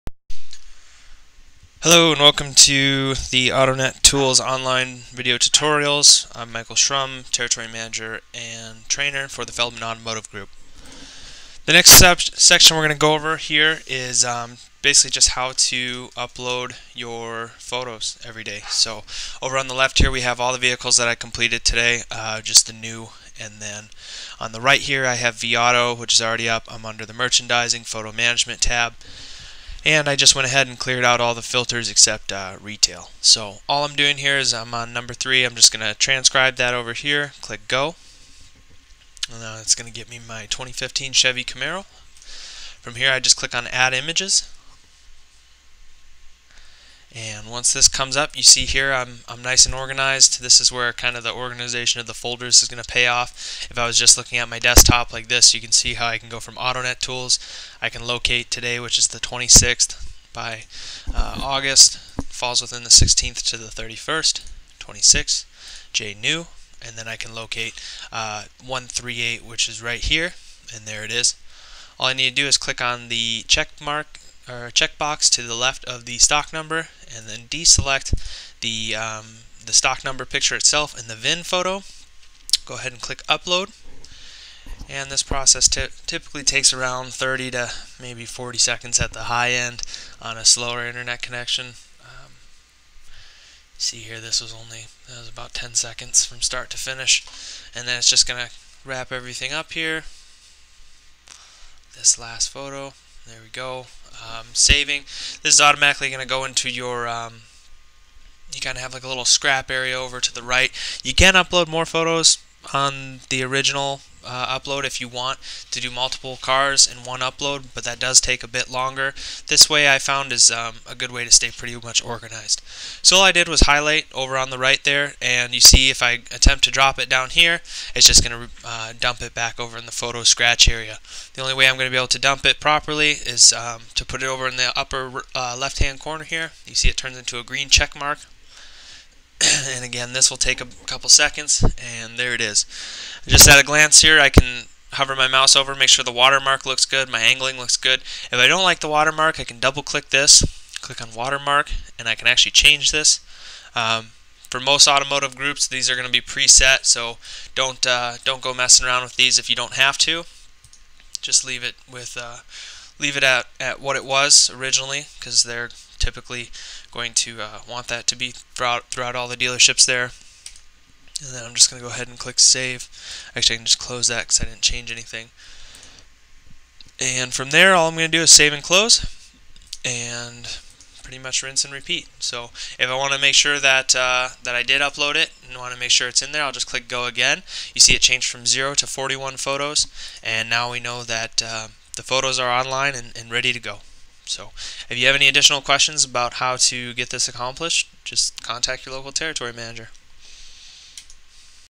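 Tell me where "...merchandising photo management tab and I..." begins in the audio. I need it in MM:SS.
00:27.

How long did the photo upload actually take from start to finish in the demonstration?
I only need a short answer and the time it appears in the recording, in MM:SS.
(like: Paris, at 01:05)
10 seconds, at 01:35.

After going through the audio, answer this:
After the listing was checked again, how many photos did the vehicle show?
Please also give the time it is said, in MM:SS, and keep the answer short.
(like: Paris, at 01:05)
41, at 03:08.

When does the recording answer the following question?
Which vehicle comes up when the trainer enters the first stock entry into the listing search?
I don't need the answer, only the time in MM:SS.
00:40.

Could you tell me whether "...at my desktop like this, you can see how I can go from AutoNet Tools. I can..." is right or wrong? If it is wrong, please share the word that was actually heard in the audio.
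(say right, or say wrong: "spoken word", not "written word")
right.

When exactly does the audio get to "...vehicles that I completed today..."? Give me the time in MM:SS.
00:20.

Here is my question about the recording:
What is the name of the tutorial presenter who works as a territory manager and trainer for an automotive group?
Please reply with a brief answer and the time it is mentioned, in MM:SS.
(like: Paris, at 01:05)
Michael Schrum, at 00:06.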